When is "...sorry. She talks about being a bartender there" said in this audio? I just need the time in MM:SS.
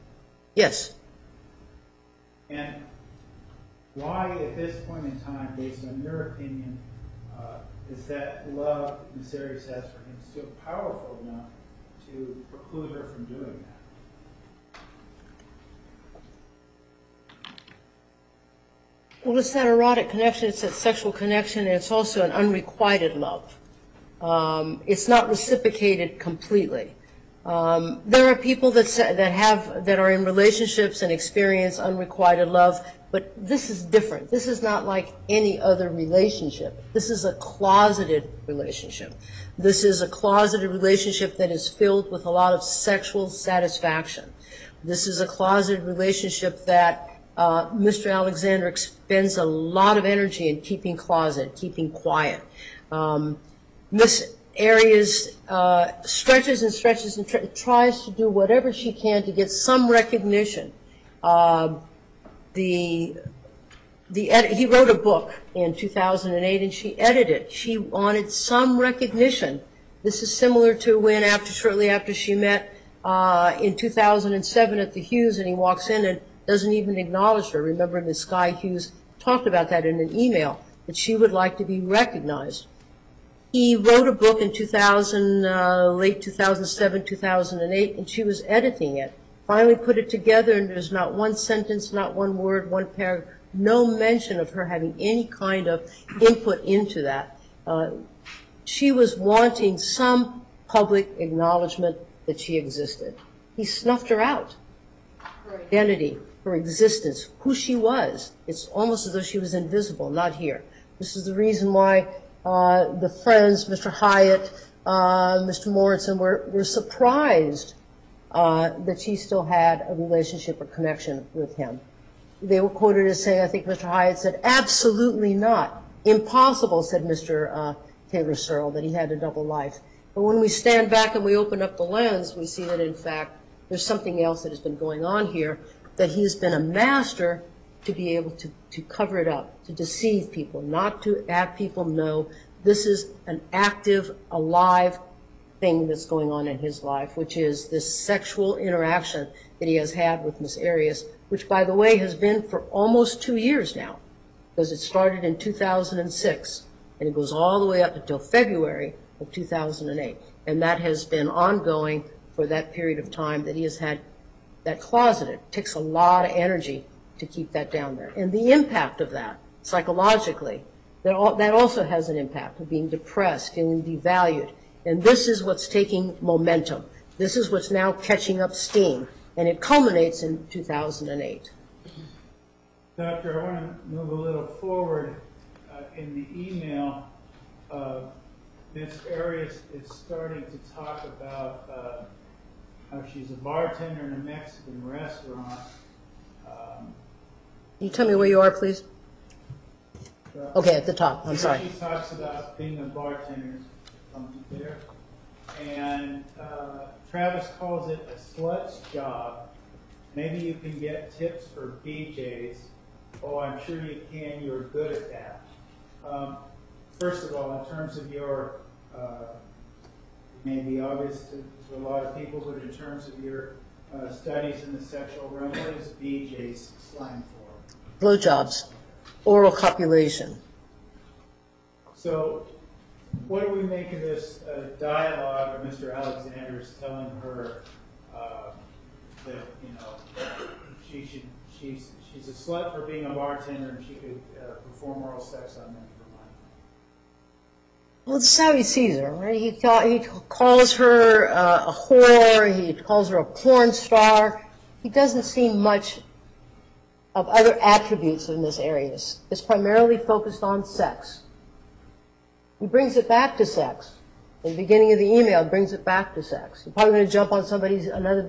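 03:21.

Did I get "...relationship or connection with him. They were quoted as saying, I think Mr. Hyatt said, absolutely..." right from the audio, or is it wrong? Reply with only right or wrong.
right.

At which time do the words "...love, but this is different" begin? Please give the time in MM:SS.
00:32.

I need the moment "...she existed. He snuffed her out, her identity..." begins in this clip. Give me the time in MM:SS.
01:42.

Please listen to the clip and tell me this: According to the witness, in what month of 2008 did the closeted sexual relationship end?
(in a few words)
February.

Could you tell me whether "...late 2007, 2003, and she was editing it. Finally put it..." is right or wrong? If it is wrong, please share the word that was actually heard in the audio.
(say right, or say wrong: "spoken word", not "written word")
wrong: "2008", not "2003".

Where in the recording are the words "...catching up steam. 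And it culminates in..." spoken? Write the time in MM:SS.
02:57.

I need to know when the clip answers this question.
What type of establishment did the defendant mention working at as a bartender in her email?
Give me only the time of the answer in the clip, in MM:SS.
03:14.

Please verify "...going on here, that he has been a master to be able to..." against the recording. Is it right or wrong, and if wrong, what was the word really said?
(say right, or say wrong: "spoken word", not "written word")
right.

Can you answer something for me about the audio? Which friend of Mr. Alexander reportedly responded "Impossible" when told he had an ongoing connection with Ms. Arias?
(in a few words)
Taylor Searle.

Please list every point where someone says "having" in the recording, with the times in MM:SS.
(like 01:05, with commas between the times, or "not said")
01:34.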